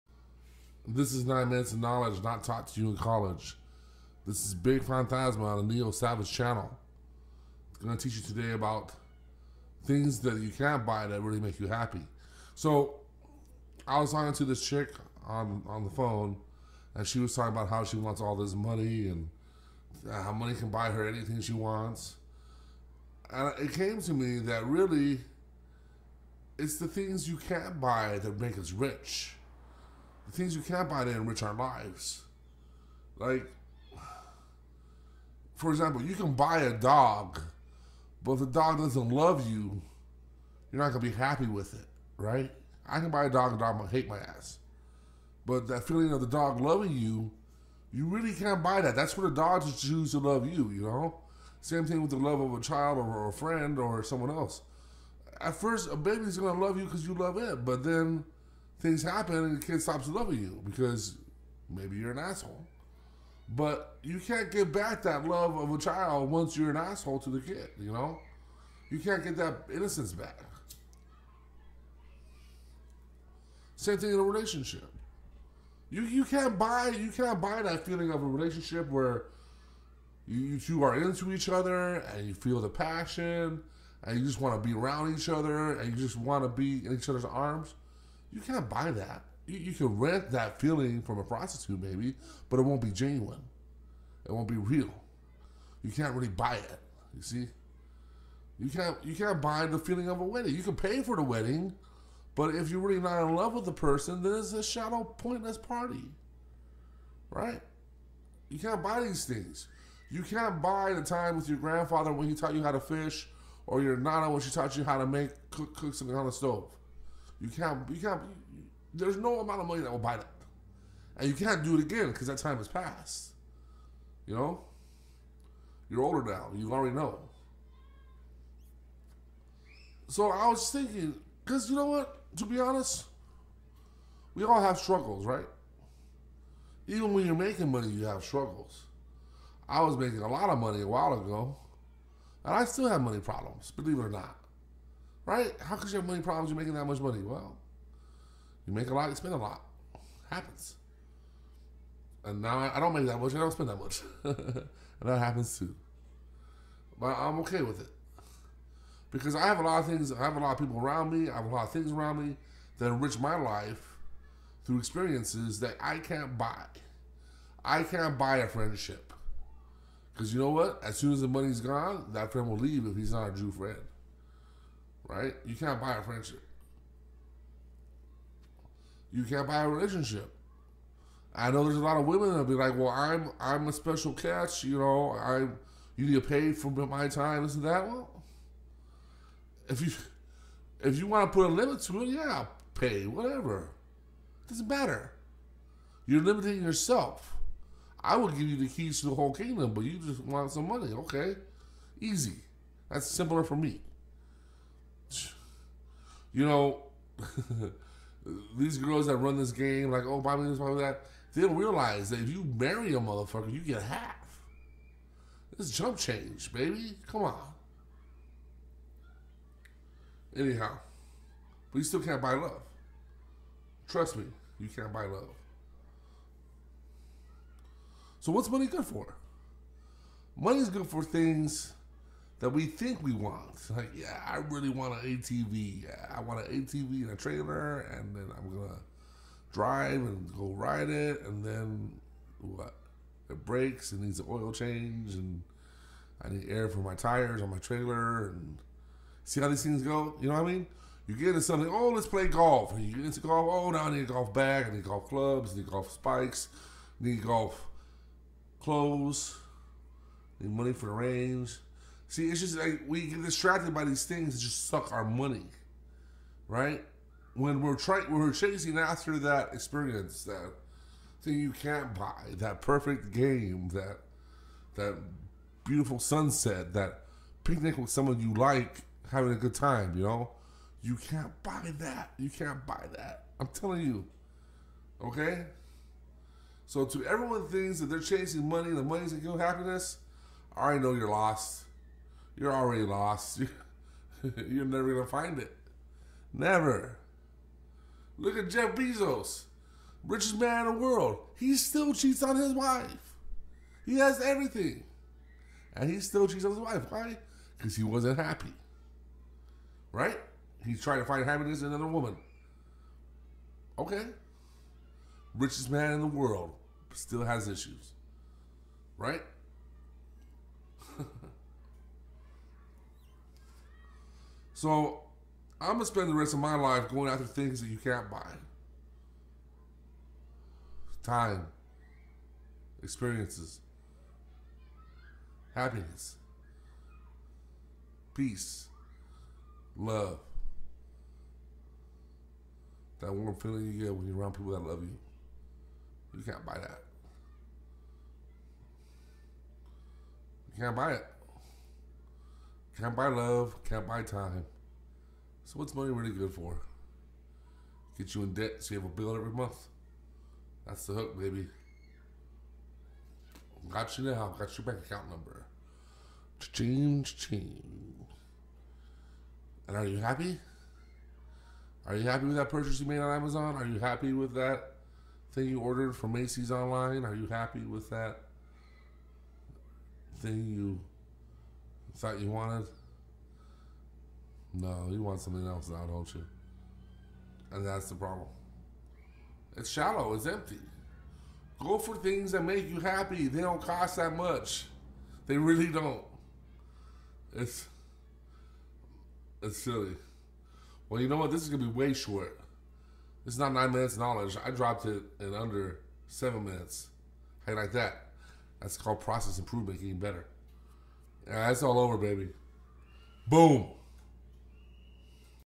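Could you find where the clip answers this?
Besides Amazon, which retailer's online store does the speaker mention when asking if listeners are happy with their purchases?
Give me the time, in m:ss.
6:16.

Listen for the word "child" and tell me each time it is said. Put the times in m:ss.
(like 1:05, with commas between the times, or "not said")
0:52, 1:05.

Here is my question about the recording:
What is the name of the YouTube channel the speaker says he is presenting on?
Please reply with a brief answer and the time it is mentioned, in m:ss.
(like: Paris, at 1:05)
Neo Savage, at 0:05.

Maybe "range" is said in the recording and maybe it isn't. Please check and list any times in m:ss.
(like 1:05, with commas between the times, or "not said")
4:20.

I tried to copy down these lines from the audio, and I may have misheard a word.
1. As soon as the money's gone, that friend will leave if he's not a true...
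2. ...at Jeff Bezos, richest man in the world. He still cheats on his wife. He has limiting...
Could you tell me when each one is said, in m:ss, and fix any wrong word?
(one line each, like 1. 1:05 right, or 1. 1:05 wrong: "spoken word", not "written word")
1. 2:50 right
2. 4:58 wrong: "everything", not "limiting".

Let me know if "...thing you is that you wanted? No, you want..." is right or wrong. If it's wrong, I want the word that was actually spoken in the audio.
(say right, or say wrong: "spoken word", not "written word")
right.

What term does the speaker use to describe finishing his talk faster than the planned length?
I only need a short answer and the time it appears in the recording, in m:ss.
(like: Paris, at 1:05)
Process improvement, at 6:48.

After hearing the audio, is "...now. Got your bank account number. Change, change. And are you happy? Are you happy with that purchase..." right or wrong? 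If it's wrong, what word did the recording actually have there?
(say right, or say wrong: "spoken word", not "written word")
right.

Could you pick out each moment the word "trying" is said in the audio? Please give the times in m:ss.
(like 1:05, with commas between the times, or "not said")
4:27, 5:10.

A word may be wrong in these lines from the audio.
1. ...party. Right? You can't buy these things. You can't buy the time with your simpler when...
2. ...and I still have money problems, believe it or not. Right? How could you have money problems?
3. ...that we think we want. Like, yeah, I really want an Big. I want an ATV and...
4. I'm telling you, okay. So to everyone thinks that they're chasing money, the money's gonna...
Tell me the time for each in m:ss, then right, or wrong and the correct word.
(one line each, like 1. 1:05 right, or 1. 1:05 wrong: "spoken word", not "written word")
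1. 1:45 wrong: "grandfather", not "simpler"
2. 2:22 right
3. 3:52 wrong: "ATV", not "Big"
4. 4:43 right.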